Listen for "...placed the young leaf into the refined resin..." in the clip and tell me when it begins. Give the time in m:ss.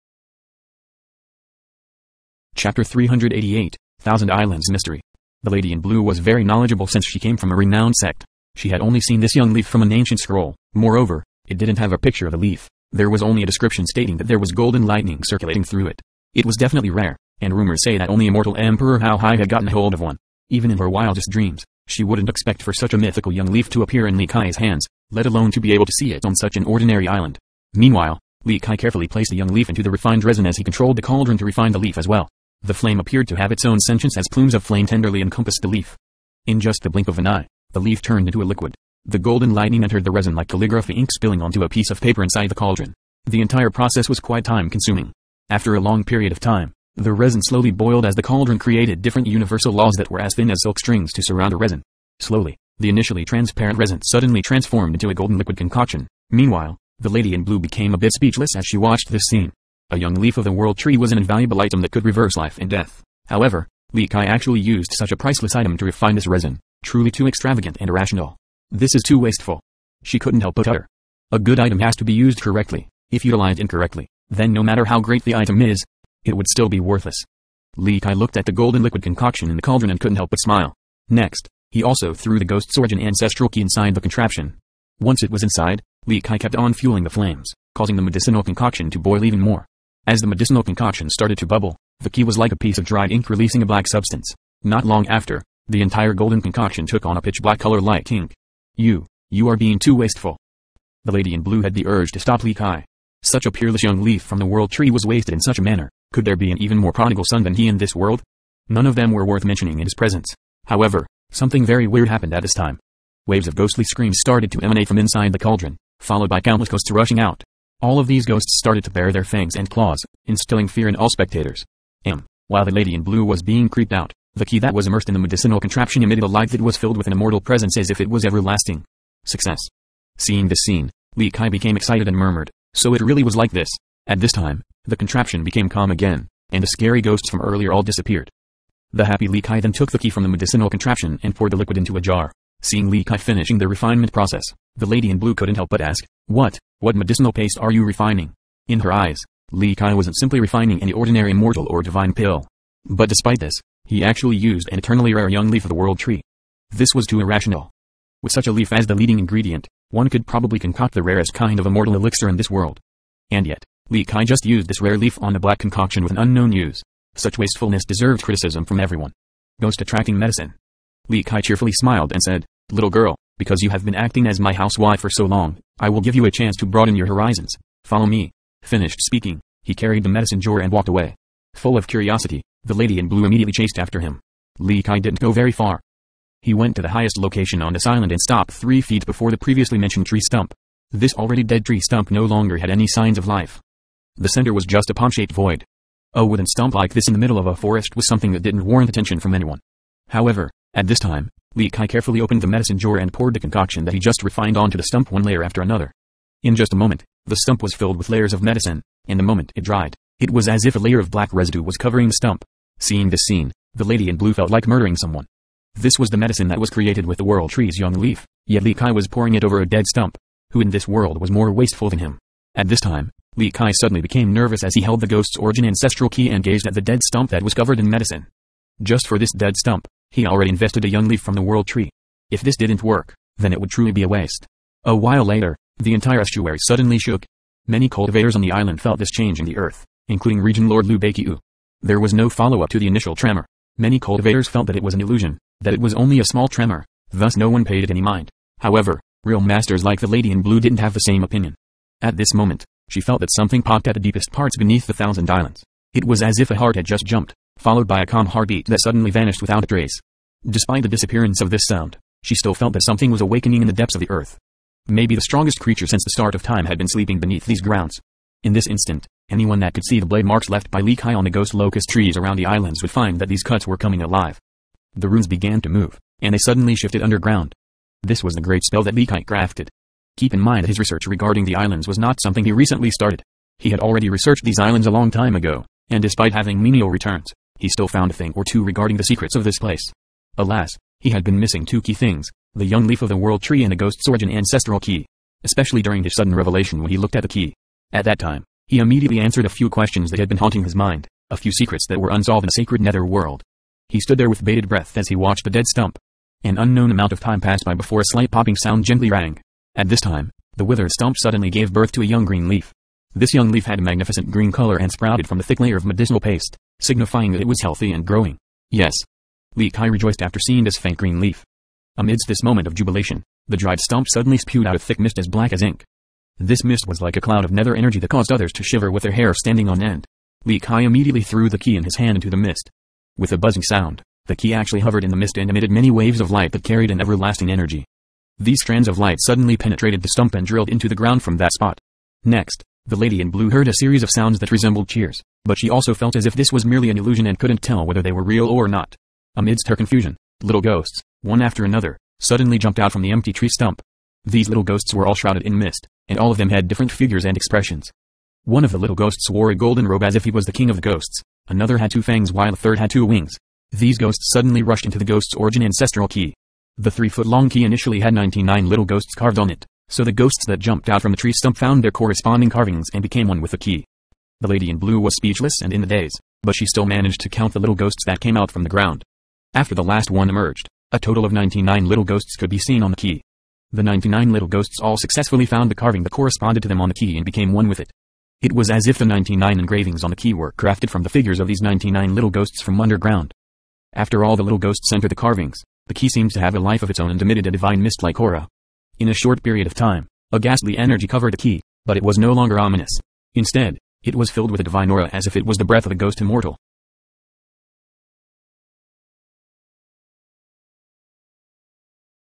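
0:29.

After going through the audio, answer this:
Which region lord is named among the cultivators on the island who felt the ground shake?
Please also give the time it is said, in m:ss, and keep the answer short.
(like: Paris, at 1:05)
Liu Beikiu, at 4:00.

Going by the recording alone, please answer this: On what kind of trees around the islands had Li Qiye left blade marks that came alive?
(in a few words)
ghost locust trees.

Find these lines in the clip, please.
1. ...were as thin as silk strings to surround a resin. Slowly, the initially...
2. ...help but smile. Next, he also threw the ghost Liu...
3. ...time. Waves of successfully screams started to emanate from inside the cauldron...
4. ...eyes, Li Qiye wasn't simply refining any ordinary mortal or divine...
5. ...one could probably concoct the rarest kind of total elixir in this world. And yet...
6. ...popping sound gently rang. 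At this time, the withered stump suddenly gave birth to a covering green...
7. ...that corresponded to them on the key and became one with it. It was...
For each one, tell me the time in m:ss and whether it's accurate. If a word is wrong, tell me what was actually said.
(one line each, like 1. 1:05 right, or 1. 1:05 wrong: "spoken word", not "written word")
1. 0:50 right
2. 1:20 wrong: "Origin", not "Liu"
3. 1:52 wrong: "ghostly", not "successfully"
4. 2:28 right
5. 2:39 wrong: "immortal", not "total"
6. 5:08 wrong: "young", not "covering"
7. 6:26 right.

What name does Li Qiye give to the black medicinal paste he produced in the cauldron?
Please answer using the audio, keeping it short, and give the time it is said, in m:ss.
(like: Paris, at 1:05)
Ghost attracting medicine, at 2:49.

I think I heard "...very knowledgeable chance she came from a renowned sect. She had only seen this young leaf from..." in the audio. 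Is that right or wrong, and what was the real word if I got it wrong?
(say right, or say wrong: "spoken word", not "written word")
wrong: "since", not "chance".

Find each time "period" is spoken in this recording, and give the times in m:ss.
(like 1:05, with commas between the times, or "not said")
0:46, 6:39.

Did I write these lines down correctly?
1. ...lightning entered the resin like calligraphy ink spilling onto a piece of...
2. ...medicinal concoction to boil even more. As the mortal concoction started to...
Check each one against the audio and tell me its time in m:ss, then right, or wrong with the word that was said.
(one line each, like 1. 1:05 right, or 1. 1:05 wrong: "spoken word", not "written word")
1. 0:39 right
2. 1:28 wrong: "medicinal", not "mortal".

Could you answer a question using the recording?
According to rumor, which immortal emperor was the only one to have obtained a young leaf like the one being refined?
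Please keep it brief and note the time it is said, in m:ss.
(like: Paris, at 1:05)
Hao Hai, at 0:18.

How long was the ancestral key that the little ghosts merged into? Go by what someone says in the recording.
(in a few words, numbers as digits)
three feet.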